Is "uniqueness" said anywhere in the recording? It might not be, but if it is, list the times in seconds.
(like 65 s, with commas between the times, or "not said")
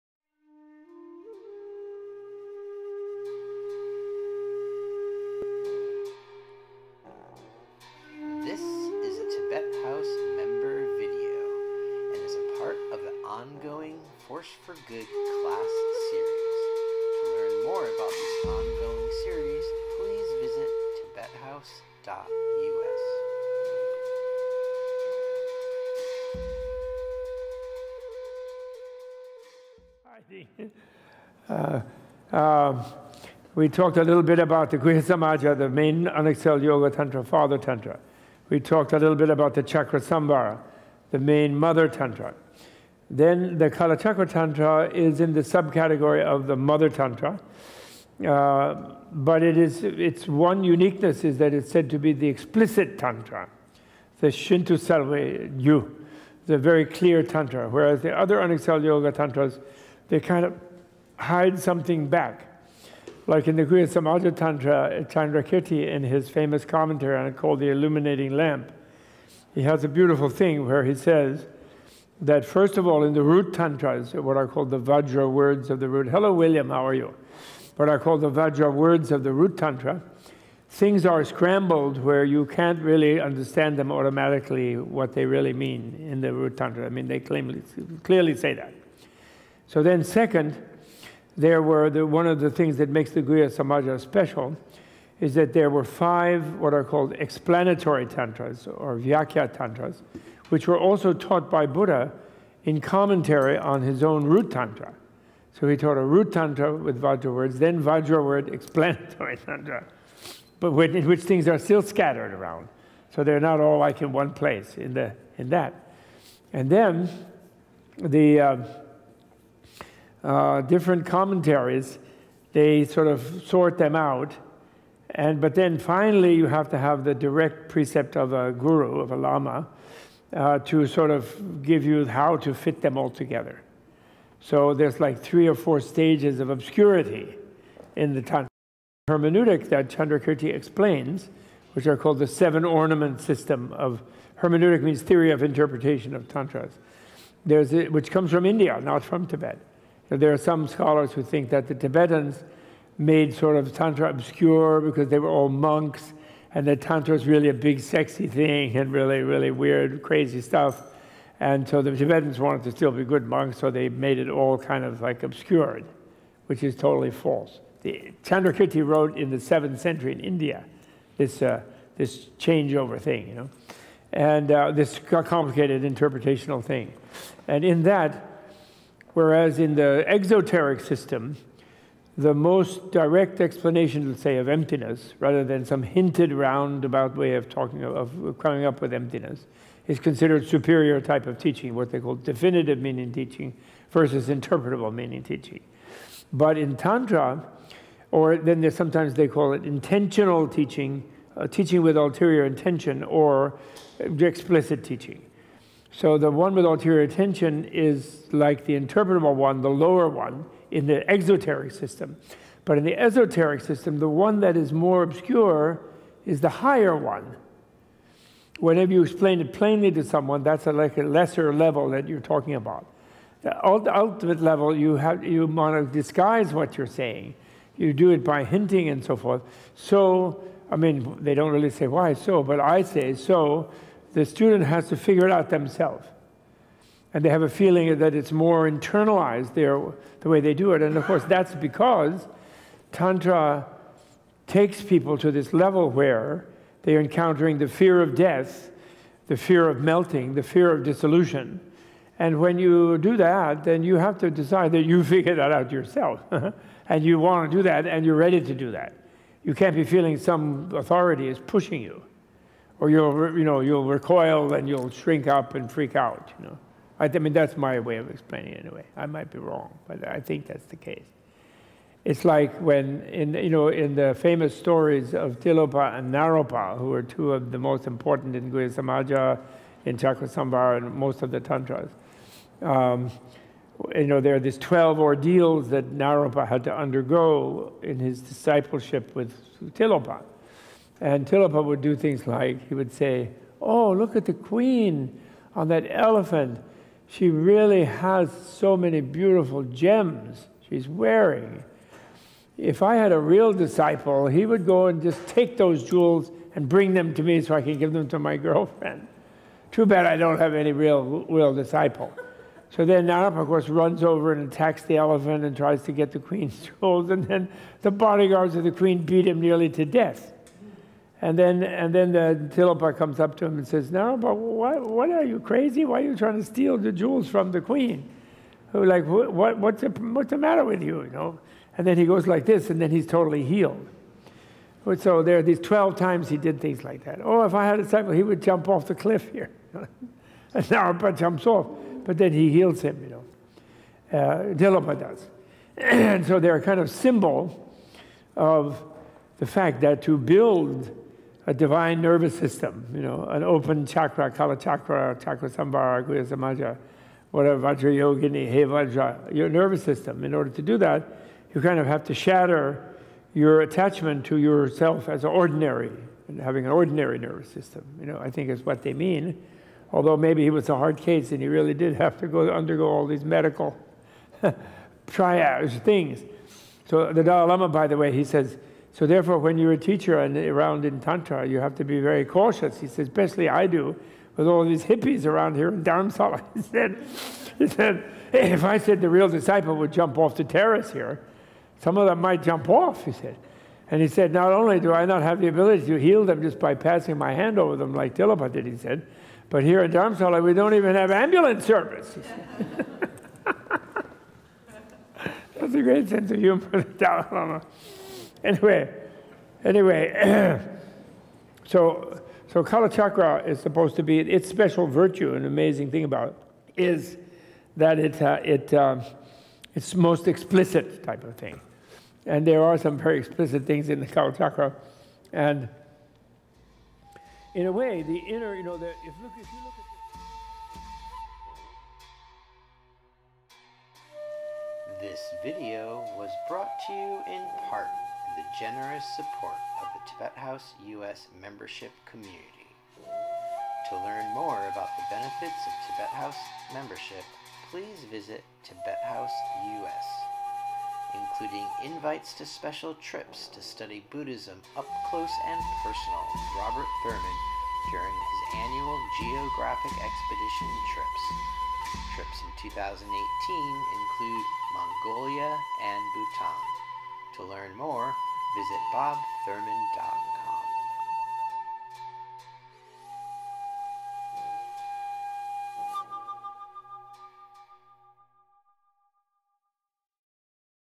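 50 s.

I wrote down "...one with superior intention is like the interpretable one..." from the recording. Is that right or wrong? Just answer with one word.
wrong.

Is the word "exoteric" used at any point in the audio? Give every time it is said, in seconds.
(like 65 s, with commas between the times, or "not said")
180 s, 211 s.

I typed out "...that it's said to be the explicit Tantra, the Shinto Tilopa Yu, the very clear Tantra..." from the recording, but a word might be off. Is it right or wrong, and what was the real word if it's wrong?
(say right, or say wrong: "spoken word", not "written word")
wrong: "Salve", not "Tilopa".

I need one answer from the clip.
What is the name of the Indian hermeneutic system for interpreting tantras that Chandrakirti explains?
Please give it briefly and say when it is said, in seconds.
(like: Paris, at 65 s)
seven ornament system, at 142 s.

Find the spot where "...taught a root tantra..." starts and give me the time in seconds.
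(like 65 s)
105 s.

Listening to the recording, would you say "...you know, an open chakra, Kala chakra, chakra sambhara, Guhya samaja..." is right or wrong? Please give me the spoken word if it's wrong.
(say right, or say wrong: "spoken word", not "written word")
right.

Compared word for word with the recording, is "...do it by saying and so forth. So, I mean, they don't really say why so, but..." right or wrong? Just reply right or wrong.
wrong.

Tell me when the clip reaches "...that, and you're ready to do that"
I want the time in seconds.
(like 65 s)
257 s.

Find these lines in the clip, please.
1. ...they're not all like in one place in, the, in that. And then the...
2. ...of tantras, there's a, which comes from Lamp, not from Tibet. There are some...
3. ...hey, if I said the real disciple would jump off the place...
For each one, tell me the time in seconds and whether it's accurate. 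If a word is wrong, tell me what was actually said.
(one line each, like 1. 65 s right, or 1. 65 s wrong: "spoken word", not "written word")
1. 113 s right
2. 146 s wrong: "India", not "Lamp"
3. 388 s wrong: "terrace", not "place".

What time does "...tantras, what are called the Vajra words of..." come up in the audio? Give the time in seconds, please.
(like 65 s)
73 s.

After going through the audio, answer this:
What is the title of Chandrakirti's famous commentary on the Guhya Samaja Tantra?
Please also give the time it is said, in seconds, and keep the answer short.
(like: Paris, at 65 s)
The Illuminating Lamp, at 67 s.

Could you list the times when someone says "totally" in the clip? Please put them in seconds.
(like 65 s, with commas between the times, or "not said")
166 s, 333 s.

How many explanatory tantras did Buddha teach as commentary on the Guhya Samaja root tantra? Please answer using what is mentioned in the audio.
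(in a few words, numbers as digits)
5.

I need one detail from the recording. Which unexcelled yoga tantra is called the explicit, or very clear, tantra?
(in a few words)
Kalachakra Tantra.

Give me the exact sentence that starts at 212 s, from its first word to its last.
But in the esoteric system, the one that is more obscure is the higher one.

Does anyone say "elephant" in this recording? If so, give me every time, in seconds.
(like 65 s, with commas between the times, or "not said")
295 s, 314 s.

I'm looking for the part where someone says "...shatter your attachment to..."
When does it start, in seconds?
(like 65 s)
362 s.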